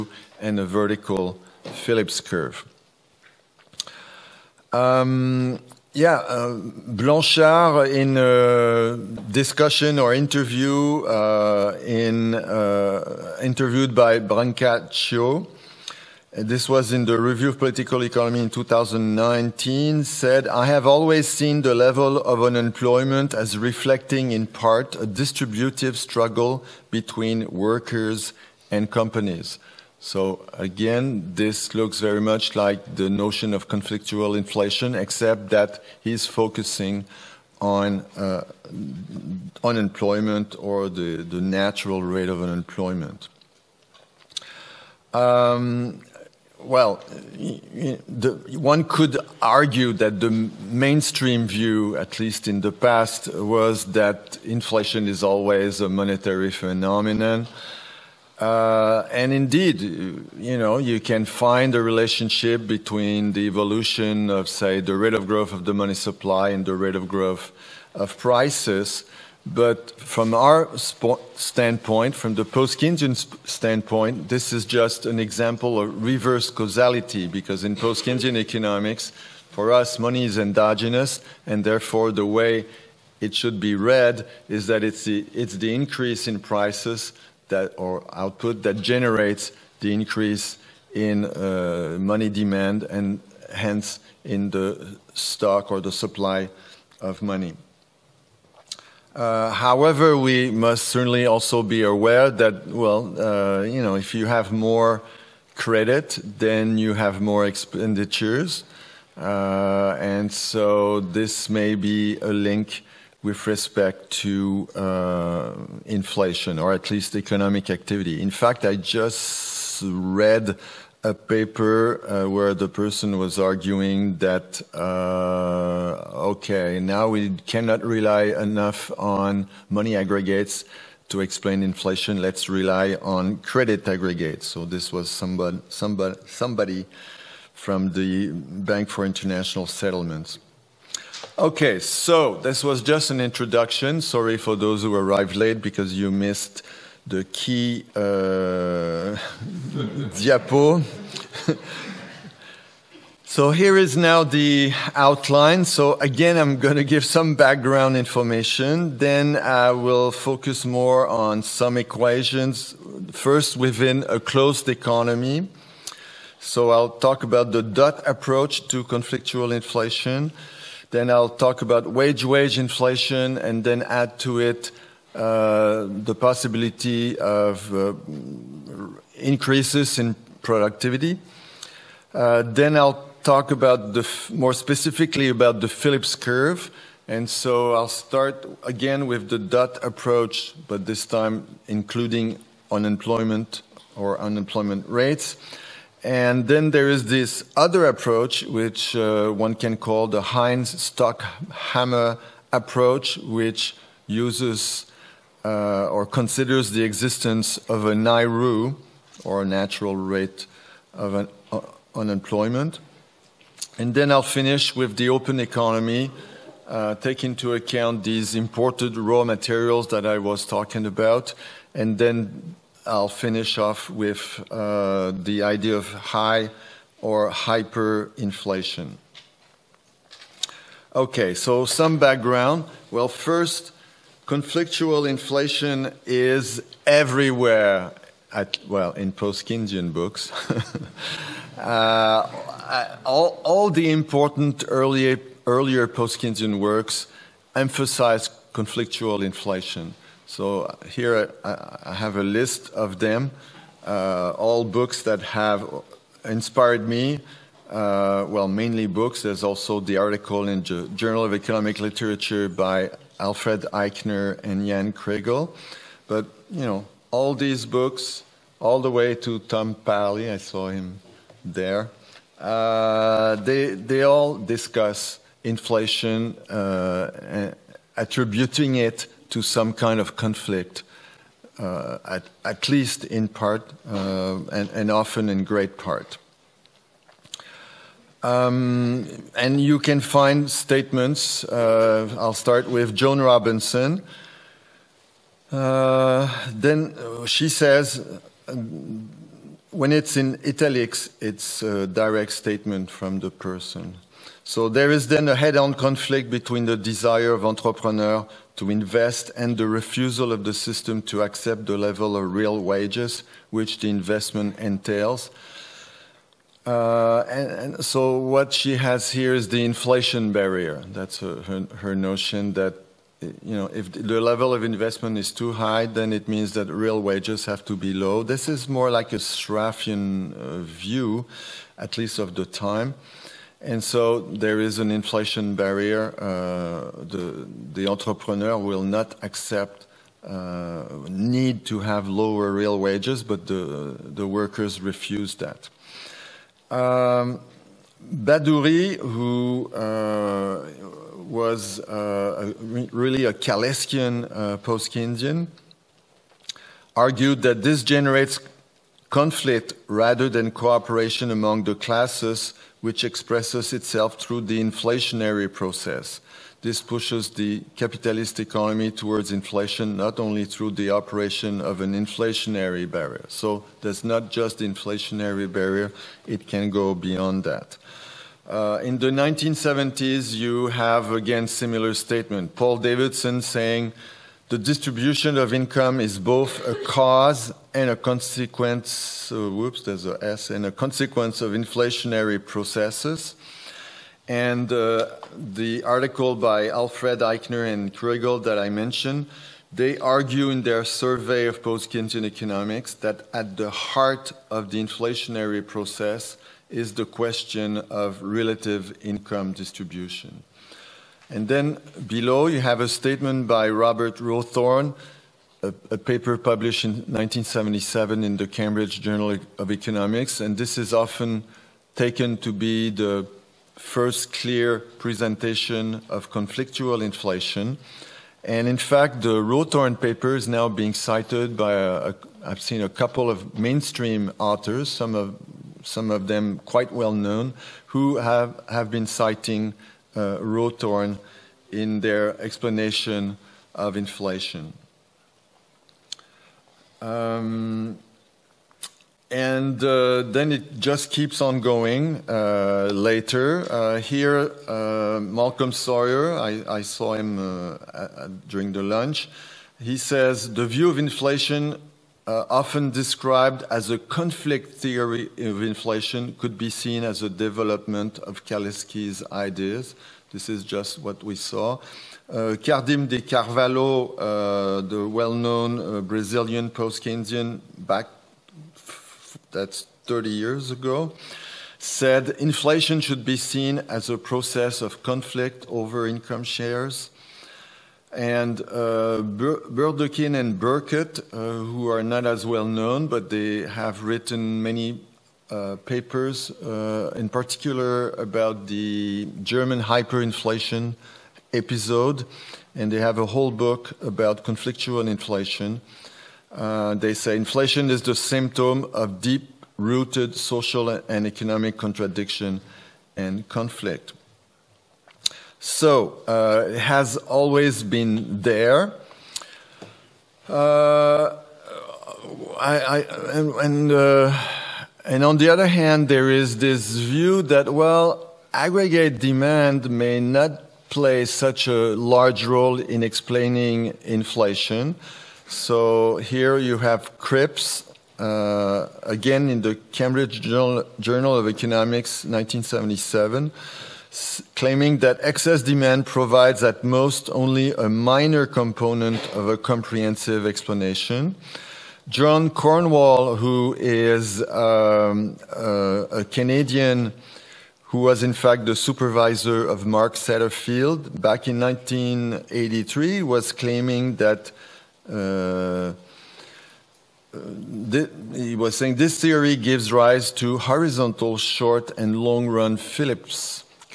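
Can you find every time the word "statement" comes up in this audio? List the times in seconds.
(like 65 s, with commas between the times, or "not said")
290 s, 302 s, 381 s, 412 s.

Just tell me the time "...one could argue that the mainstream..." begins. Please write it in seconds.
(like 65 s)
48 s.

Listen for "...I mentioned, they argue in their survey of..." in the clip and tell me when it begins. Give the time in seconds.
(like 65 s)
398 s.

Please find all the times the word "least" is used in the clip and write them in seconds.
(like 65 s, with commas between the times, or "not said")
52 s, 116 s, 282 s, 331 s.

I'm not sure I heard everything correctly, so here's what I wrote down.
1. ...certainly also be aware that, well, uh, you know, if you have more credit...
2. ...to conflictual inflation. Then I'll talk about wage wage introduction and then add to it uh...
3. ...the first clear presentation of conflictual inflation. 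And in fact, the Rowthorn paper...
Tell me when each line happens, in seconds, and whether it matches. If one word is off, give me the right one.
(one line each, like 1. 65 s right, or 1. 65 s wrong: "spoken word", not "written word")
1. 100 s right
2. 168 s wrong: "inflation", not "introduction"
3. 422 s right.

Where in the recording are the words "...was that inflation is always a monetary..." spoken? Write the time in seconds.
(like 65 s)
53 s.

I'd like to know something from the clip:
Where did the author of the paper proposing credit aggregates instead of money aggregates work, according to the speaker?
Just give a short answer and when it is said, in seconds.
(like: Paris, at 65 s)
Bank for International Settlements, at 138 s.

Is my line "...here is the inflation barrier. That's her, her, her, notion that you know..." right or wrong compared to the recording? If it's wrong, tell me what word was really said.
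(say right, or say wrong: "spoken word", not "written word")
right.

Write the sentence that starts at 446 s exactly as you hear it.
Um, and uh, then it just keeps on going uh, later.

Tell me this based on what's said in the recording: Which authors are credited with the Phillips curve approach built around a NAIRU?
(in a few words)
Heinz Stockhammer.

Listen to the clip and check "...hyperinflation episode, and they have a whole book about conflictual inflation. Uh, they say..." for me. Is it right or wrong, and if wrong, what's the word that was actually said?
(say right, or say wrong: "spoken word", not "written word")
right.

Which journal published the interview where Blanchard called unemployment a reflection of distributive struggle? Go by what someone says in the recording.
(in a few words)
Review of Political Economy.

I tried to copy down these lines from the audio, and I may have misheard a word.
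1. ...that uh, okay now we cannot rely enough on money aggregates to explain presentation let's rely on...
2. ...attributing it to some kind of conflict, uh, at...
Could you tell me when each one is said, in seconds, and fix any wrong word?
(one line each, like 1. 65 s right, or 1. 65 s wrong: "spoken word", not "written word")
1. 124 s wrong: "inflation", not "presentation"
2. 277 s right.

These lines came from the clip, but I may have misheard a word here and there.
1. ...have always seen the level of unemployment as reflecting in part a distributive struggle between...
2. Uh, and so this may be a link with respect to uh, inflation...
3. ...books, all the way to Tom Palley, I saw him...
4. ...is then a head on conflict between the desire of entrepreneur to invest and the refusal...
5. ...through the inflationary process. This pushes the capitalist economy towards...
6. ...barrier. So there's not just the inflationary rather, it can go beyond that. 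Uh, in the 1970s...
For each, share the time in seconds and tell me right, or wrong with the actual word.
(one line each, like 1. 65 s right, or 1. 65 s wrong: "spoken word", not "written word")
1. 20 s right
2. 109 s right
3. 267 s right
4. 304 s right
5. 364 s right
6. 372 s wrong: "barrier", not "rather".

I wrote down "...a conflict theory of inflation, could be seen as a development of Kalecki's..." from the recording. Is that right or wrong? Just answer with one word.
right.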